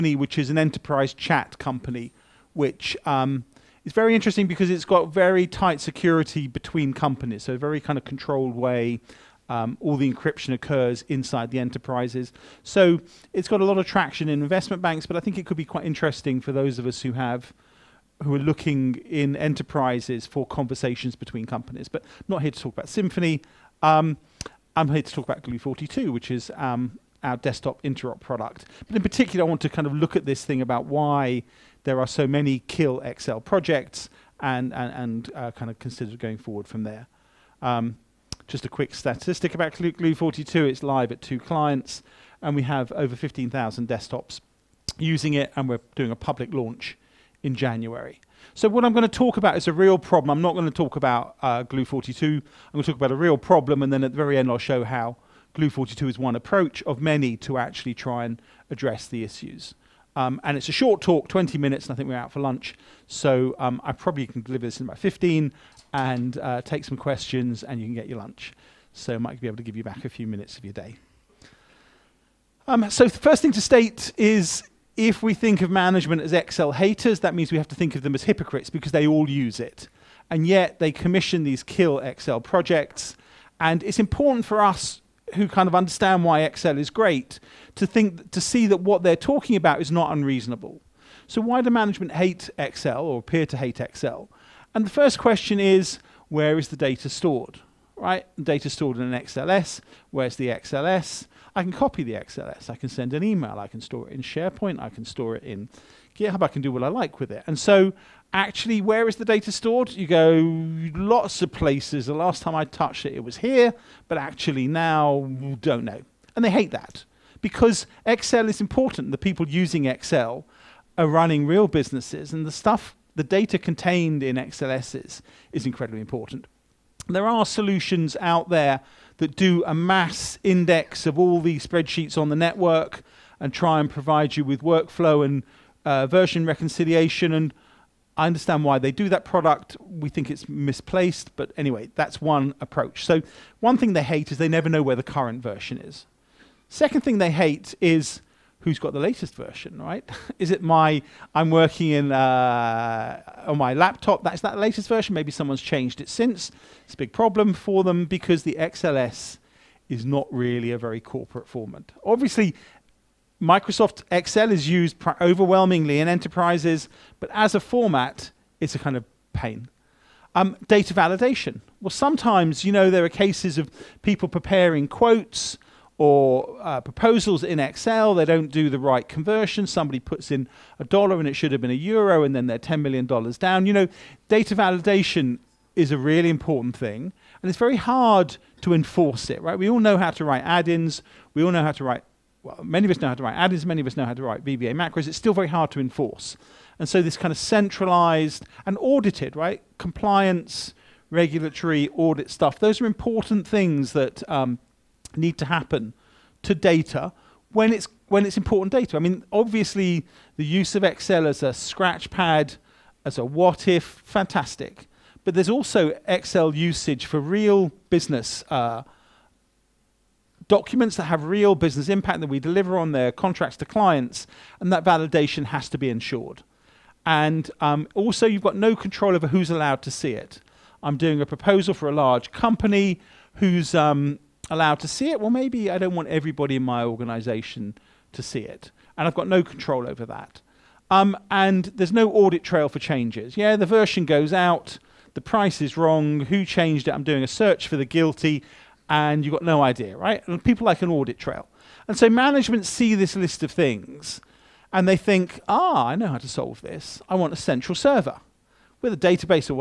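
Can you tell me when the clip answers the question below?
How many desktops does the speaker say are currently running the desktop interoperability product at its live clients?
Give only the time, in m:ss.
0:43.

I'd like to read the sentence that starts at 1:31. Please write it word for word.
So why do management hate Excel or appear to hate Excel?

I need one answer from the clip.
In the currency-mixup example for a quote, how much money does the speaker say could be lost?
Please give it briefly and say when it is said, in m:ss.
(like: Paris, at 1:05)
$10 million, at 3:02.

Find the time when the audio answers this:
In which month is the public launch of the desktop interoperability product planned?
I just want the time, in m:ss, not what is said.
0:47.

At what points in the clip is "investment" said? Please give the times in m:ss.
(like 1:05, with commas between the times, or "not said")
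0:14.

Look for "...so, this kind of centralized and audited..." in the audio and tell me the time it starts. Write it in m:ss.
3:16.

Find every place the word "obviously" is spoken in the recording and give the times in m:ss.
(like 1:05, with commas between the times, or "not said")
2:42, 3:29.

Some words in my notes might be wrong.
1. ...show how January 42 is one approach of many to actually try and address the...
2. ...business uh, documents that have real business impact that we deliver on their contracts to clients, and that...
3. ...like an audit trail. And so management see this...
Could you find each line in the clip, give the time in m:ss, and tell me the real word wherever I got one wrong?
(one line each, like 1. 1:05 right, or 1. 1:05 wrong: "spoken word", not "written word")
1. 0:54 wrong: "Glue", not "January"
2. 3:37 right
3. 4:10 right.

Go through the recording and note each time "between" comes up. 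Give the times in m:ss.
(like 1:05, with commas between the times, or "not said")
0:06, 0:21.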